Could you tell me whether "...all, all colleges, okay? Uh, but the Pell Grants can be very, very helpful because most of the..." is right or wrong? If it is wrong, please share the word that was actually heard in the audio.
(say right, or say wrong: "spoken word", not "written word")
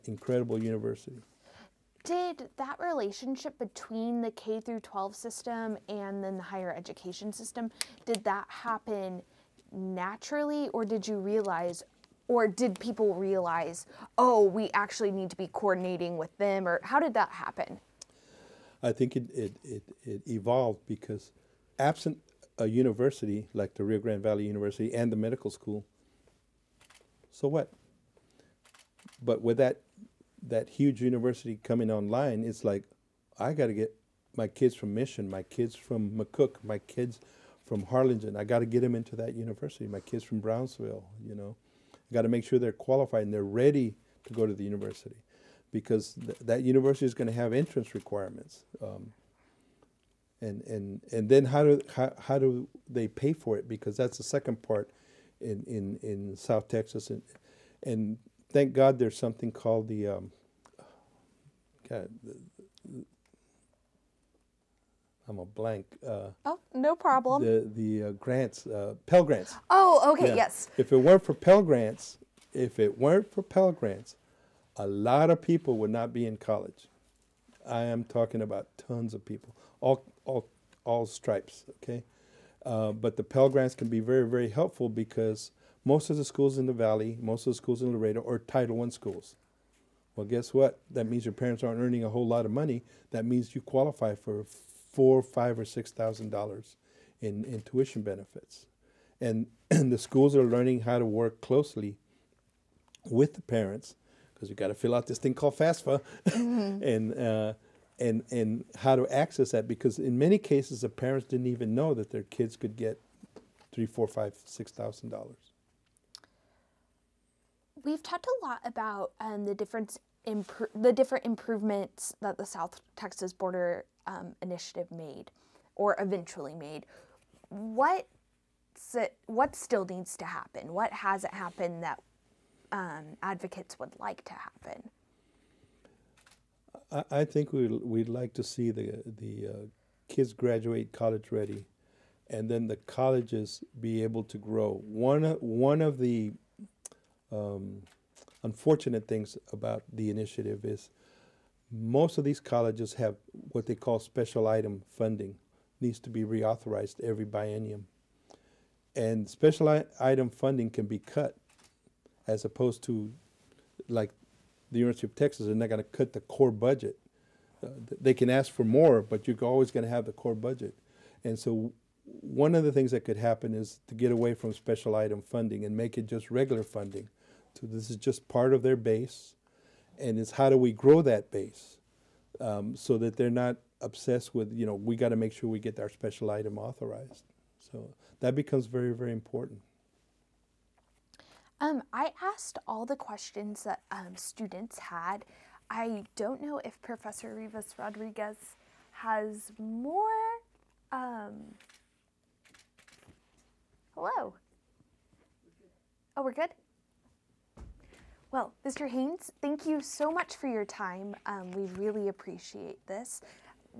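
wrong: "stripes", not "colleges".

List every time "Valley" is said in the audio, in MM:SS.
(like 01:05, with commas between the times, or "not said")
00:24, 01:26.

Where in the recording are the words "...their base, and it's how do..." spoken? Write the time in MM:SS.
02:58.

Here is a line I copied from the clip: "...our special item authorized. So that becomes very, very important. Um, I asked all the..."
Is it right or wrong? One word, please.
right.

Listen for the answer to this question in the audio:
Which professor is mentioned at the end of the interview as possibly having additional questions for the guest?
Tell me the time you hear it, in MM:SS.
03:16.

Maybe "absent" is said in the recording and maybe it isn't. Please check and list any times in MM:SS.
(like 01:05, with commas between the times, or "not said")
00:21.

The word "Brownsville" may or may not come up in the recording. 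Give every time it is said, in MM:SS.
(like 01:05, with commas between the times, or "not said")
00:40.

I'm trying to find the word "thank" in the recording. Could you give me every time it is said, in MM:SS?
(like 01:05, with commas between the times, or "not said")
00:58, 03:29.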